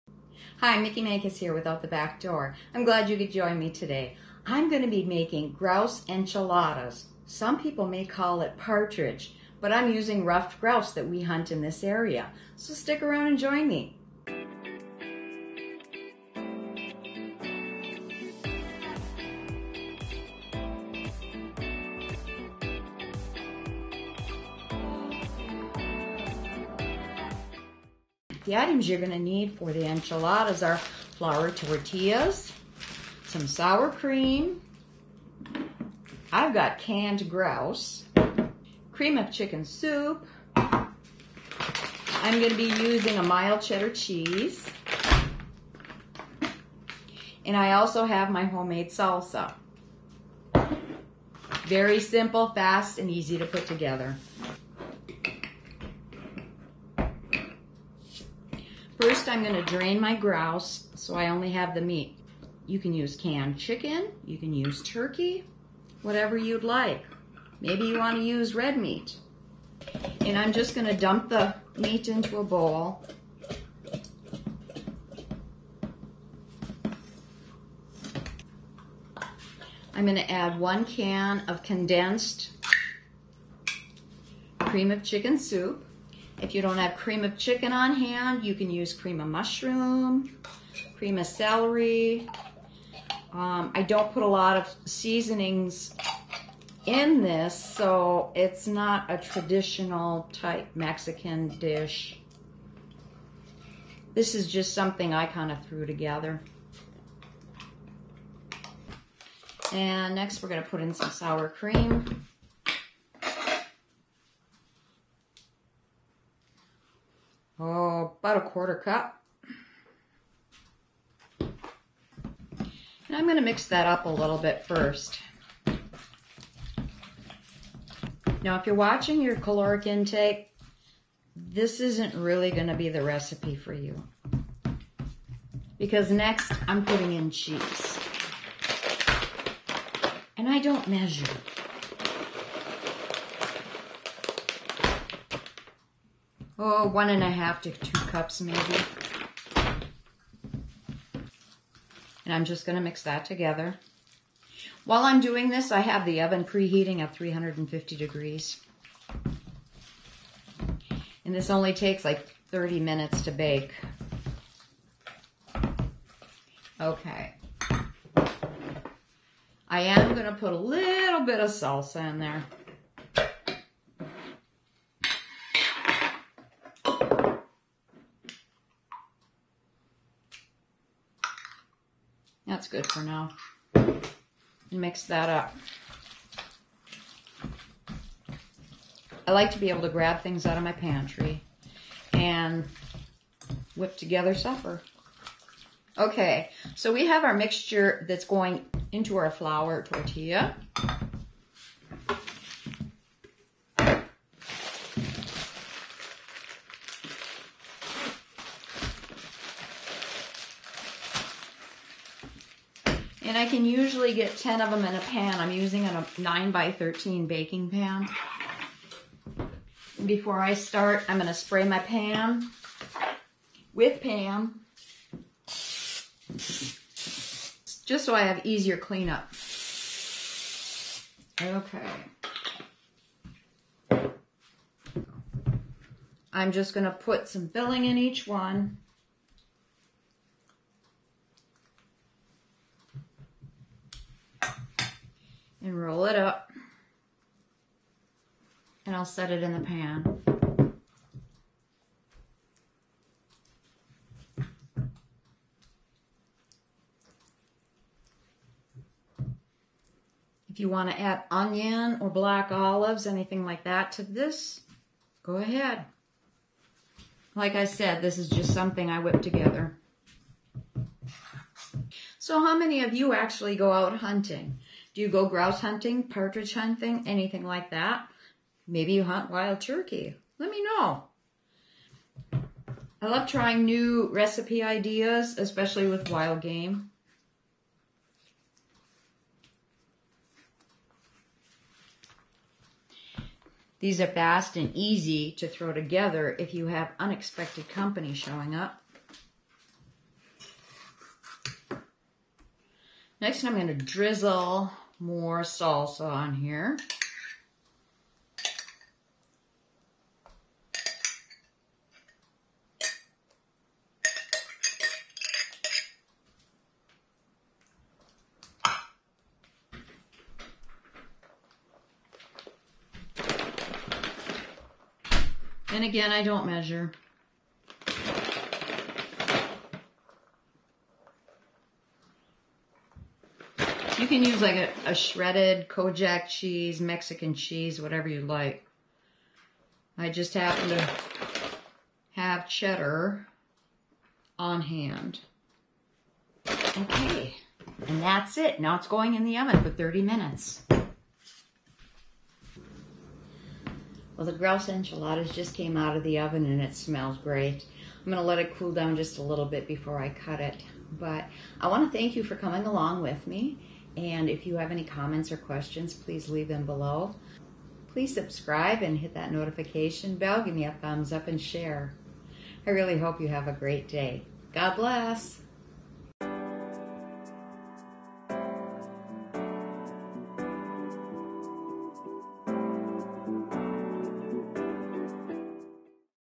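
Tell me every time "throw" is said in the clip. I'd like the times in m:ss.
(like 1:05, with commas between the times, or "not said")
4:55.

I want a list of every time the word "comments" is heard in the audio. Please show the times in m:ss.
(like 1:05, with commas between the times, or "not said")
6:04.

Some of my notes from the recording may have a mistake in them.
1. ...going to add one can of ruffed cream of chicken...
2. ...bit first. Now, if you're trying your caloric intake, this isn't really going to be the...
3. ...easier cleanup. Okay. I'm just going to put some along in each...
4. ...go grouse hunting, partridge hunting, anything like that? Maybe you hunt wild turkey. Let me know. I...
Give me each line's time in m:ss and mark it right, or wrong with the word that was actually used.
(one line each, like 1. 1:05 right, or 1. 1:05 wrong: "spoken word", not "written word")
1. 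1:20 wrong: "condensed", not "ruffed"
2. 2:04 wrong: "watching", not "trying"
3. 3:48 wrong: "filling", not "along"
4. 4:35 right.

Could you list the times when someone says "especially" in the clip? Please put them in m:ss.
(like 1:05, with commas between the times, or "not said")
4:45.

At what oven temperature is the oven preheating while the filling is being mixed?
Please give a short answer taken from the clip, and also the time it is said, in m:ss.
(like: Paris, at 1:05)
350 degrees, at 2:37.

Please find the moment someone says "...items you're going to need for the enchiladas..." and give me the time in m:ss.
0:28.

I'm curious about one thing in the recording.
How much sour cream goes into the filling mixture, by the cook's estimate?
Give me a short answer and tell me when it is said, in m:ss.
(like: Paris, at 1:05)
quarter cup, at 1:58.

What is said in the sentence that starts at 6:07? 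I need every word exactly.
Please subscribe and hit that notification bell.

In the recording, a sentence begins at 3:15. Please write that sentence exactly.
Okay, so we have our mixture that's going into our flour tortilla.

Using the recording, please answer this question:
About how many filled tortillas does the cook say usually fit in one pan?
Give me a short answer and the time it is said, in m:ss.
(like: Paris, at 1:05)
10, at 3:34.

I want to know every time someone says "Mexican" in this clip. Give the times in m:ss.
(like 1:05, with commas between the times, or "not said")
1:40, 5:36.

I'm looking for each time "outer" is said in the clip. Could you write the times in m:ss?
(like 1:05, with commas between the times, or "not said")
not said.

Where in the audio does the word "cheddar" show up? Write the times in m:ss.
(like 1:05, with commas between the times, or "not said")
0:43, 5:42.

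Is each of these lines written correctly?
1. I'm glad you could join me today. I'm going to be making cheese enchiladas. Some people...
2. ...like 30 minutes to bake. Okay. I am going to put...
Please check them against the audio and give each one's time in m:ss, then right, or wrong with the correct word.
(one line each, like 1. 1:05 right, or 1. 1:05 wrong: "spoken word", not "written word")
1. 0:02 wrong: "grouse", not "cheese"
2. 2:42 right.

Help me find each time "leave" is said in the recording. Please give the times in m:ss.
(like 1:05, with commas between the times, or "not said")
6:06.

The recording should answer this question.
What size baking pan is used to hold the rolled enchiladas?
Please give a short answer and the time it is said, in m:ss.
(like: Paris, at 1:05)
9 by 13, at 3:36.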